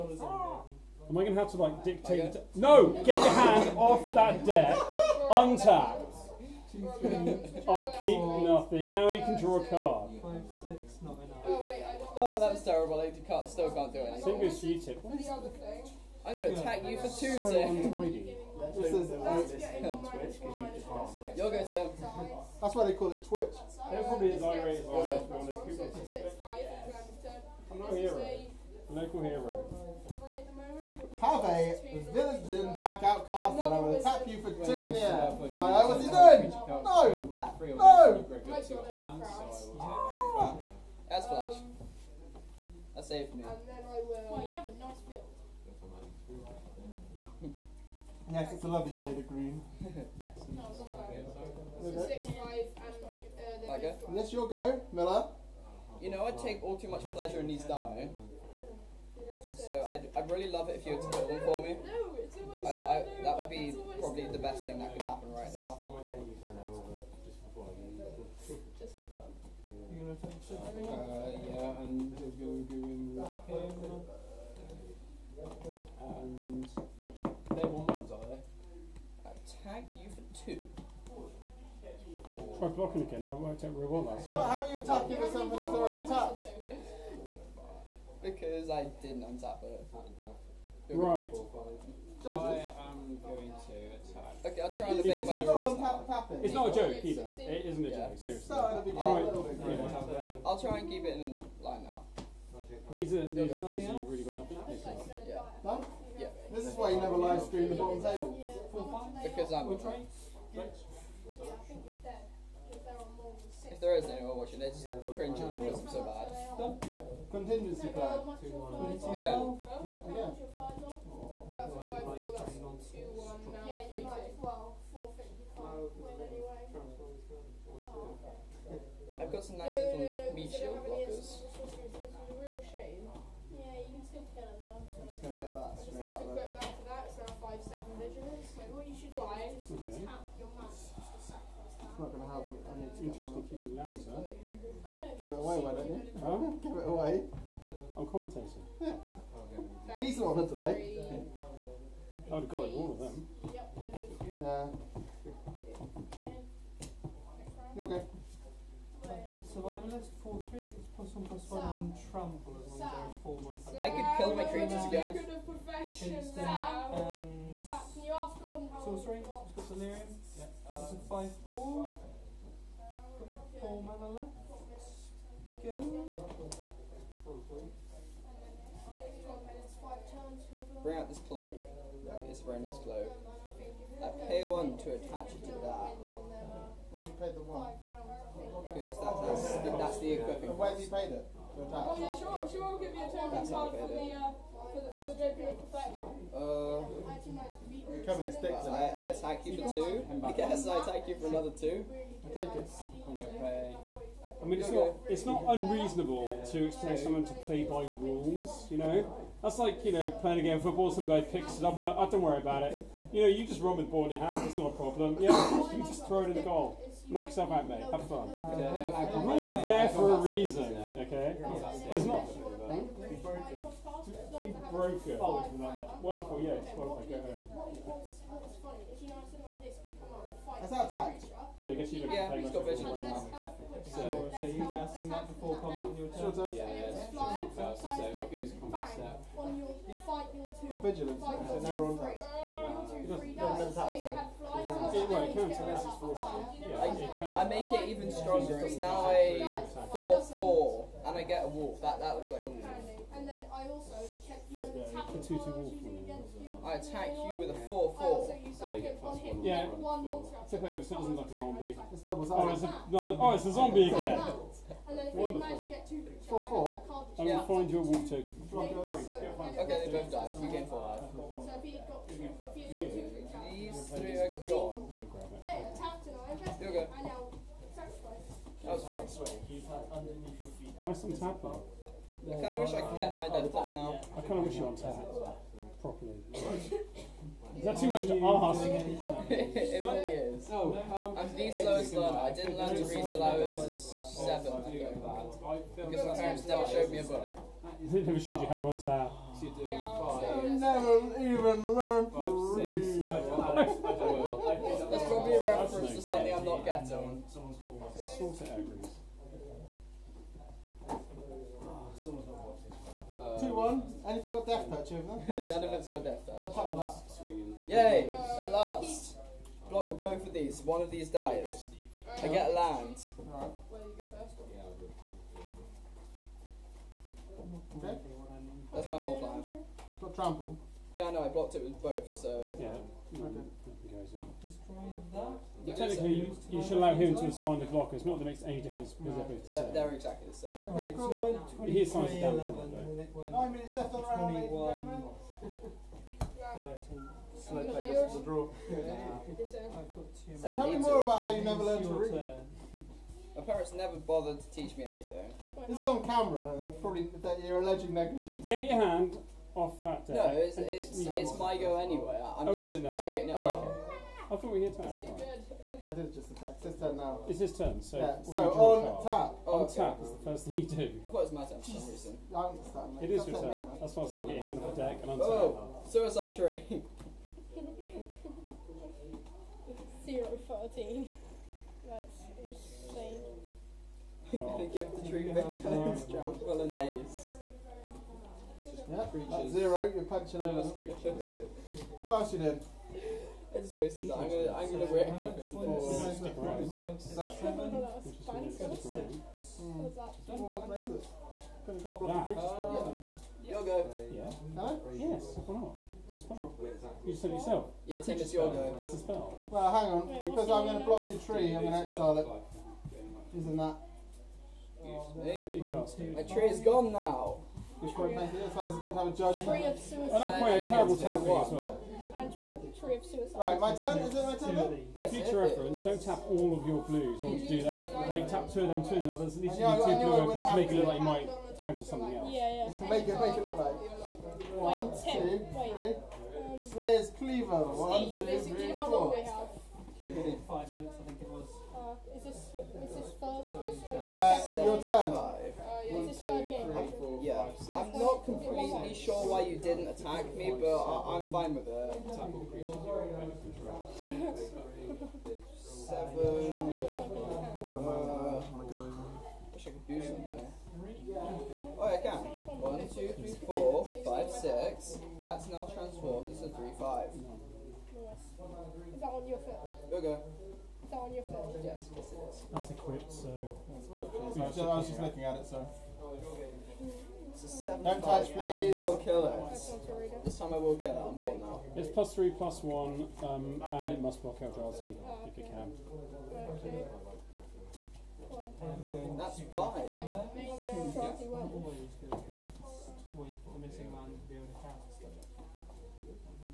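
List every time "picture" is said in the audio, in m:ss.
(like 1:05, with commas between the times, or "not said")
6:25, 6:42.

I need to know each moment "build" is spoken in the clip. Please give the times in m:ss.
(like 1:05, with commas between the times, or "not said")
0:45, 1:01.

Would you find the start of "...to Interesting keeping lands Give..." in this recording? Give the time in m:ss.
2:22.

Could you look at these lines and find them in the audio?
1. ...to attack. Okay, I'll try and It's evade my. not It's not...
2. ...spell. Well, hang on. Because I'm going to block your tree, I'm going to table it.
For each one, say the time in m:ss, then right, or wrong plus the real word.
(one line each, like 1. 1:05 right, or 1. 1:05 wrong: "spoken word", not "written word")
1. 1:33 right
2. 6:48 wrong: "exile", not "table".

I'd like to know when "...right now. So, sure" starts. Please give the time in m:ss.
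3:52.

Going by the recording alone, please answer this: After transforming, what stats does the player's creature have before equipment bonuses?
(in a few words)
3/5.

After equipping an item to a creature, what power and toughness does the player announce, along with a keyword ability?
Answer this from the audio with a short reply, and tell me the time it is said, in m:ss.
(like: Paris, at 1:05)
5/7 vigilance, at 2:17.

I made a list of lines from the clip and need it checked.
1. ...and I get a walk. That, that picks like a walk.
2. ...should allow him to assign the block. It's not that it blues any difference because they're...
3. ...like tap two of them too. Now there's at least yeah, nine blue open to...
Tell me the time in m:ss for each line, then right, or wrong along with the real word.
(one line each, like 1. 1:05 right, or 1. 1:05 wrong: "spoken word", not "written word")
1. 4:11 wrong: "looks", not "picks"
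2. 5:36 wrong: "makes", not "blues"
3. 7:08 wrong: "two", not "nine".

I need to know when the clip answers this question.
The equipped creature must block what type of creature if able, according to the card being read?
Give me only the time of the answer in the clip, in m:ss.
8:04.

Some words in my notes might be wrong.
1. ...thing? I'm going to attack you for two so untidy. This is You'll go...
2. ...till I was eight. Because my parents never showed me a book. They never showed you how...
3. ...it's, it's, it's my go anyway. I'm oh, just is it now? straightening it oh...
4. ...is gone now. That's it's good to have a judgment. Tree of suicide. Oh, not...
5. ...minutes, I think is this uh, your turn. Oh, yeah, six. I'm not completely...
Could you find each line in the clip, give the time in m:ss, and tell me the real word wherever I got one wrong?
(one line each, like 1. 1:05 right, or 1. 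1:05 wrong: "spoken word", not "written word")
1. 0:15 right
2. 4:52 wrong: "seven", not "eight"
3. 6:00 right
4. 6:56 right
5. 7:20 right.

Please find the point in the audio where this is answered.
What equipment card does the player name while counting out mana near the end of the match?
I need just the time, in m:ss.
7:16.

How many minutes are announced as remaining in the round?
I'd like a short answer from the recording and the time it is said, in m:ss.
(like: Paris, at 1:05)
9, at 5:42.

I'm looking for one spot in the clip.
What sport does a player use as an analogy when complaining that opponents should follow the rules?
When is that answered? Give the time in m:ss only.
3:30.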